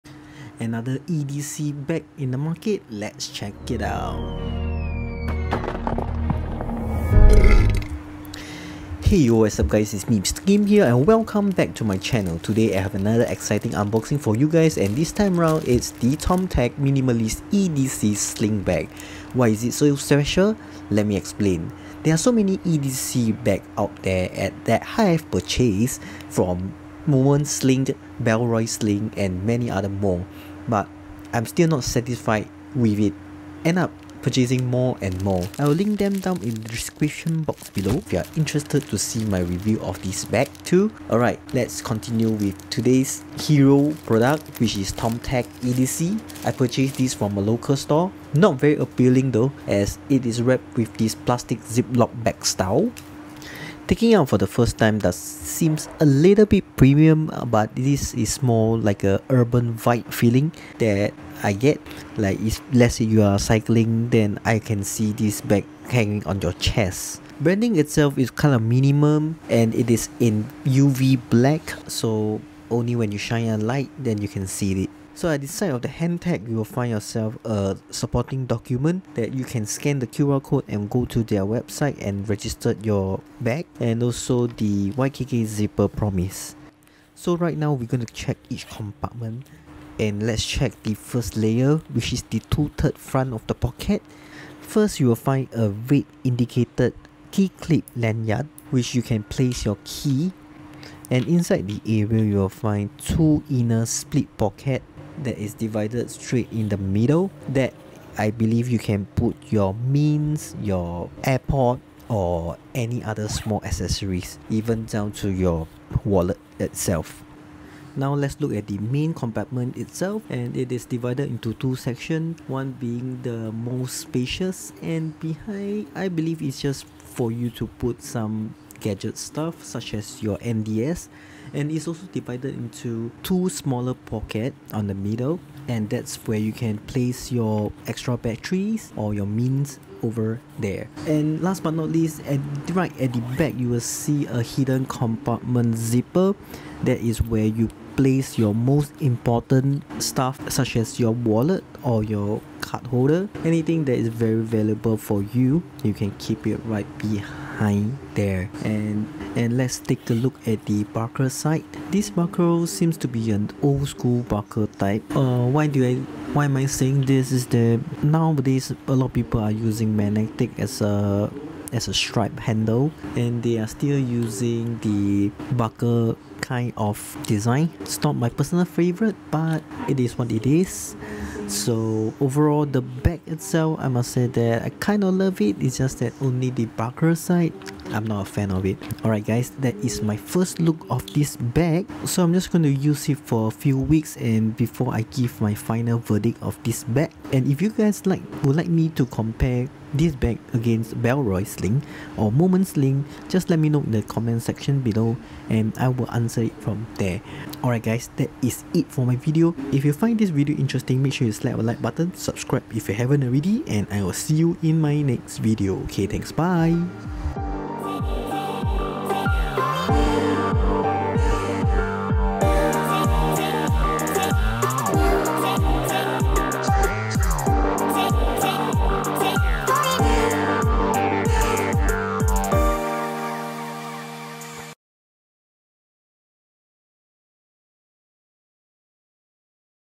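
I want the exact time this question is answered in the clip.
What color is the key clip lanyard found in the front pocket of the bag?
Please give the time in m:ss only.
1:35.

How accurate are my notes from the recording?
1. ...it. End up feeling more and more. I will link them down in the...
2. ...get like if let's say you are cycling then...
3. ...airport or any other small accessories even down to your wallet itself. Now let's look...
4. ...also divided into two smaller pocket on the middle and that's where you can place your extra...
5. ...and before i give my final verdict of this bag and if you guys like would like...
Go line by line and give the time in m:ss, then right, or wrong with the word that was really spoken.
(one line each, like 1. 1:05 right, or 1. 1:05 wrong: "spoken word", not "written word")
1. 0:32 wrong: "purchasing", not "feeling"
2. 1:01 right
3. 1:51 right
4. 2:11 right
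5. 3:14 right.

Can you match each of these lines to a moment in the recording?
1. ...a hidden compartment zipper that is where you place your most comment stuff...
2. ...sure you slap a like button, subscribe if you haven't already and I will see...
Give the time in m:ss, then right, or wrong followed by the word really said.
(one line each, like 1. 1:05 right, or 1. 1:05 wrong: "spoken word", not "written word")
1. 2:24 wrong: "important", not "comment"
2. 3:31 right.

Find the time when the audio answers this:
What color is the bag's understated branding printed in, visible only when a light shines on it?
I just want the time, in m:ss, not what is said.
1:10.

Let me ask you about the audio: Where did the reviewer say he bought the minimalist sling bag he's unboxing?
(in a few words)
A local store.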